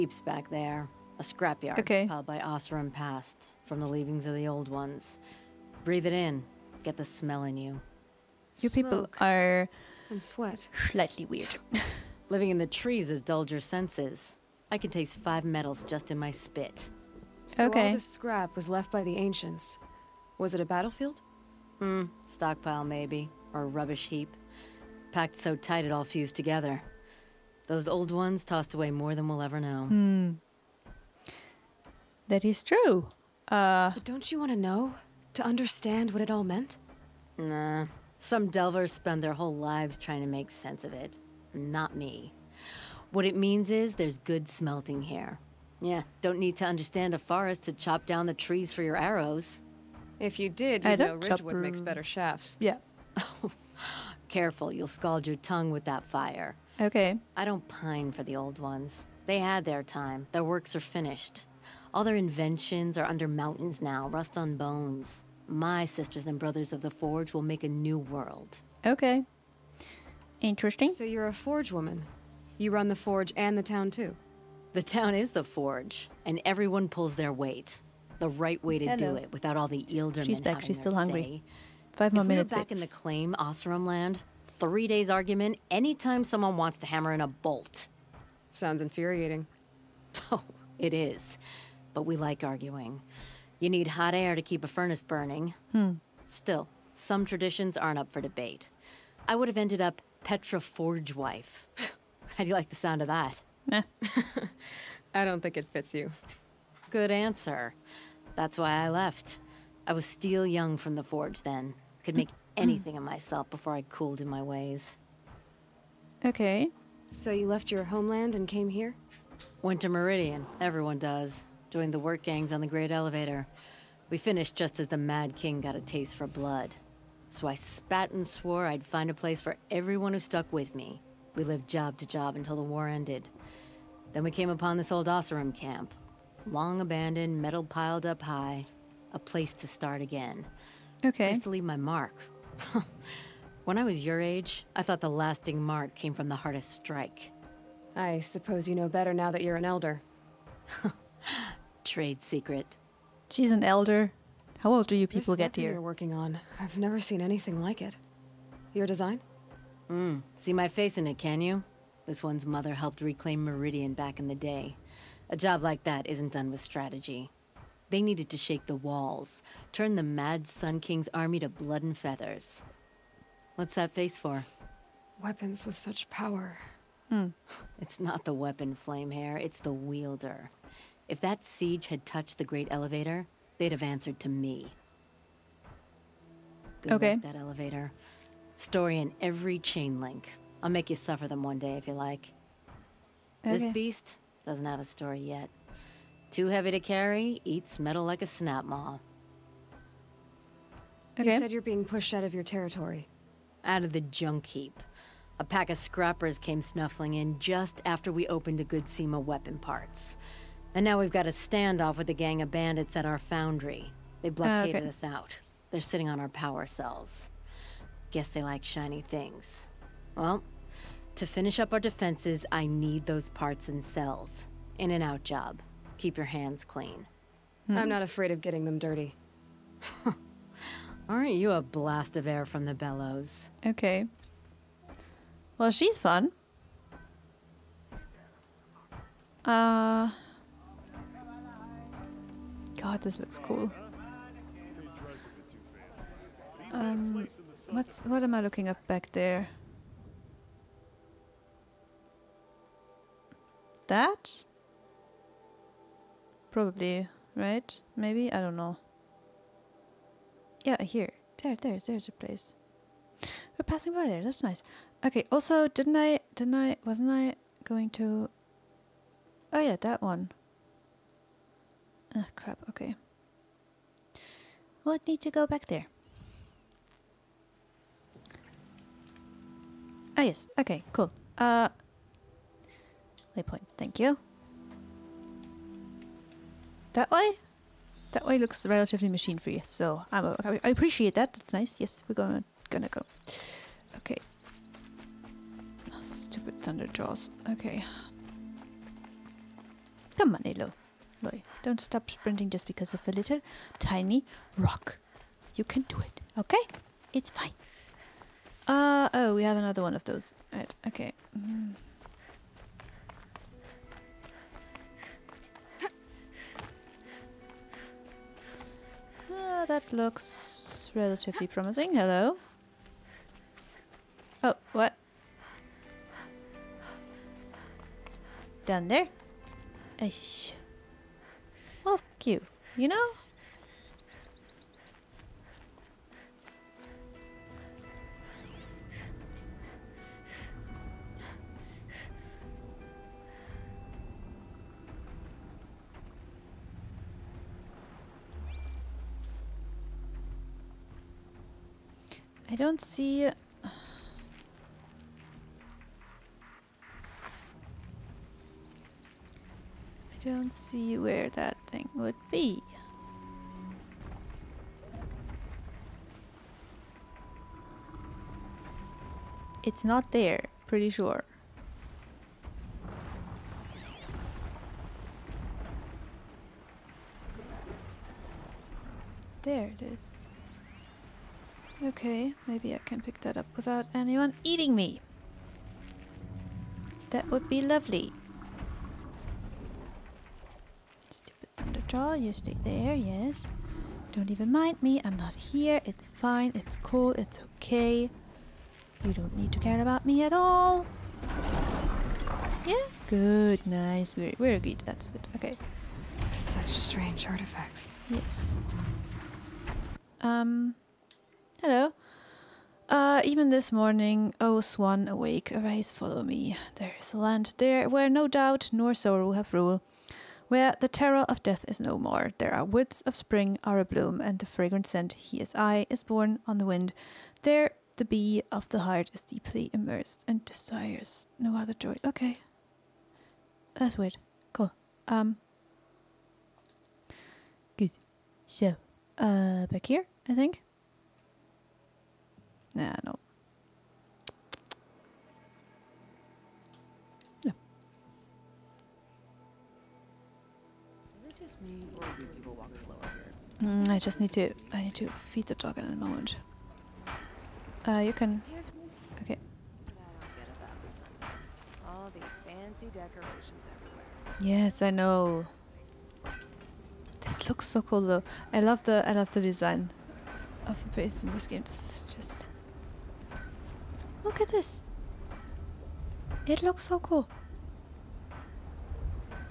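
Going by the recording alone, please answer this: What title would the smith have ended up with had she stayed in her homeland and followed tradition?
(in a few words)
Petra Forge wife.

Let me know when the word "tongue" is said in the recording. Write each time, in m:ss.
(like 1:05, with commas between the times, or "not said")
0:55.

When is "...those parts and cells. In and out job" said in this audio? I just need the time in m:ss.
3:43.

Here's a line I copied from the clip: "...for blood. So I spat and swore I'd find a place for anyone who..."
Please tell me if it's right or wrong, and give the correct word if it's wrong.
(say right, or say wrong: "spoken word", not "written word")
wrong: "everyone", not "anyone".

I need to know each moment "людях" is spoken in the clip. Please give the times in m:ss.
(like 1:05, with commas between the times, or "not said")
not said.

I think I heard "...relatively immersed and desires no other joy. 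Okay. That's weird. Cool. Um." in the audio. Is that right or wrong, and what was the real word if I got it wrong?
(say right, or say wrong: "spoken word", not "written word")
wrong: "deeply", not "relatively".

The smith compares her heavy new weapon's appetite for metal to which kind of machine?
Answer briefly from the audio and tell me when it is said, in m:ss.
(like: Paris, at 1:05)
Snapmaw, at 3:18.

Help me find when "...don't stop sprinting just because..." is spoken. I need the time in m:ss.
5:01.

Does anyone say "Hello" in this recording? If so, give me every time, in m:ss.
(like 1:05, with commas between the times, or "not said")
1:18, 5:21, 6:51.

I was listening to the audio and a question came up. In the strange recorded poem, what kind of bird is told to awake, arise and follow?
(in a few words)
swan.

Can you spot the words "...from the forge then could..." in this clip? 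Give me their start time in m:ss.
1:50.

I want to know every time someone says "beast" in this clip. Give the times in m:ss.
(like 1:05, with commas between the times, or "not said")
3:13.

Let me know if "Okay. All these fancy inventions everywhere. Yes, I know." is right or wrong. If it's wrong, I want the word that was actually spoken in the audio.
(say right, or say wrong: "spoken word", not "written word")
wrong: "decorations", not "inventions".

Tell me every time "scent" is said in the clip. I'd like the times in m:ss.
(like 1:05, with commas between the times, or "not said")
7:04.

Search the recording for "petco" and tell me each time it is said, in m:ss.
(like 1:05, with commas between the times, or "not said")
not said.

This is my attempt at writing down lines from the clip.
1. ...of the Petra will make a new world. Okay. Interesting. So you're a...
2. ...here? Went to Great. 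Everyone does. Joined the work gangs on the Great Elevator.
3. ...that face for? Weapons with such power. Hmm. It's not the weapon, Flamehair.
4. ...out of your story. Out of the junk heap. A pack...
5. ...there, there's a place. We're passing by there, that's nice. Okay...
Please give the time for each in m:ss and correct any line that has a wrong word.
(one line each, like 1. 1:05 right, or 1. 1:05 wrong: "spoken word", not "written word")
1. 1:06 wrong: "Forge", not "Petra"
2. 1:58 wrong: "Meridian", not "Great"
3. 2:53 right
4. 3:22 wrong: "territory", not "story"
5. 4:21 right.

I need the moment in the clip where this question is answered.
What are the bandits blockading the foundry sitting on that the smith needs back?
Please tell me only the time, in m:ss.
3:36.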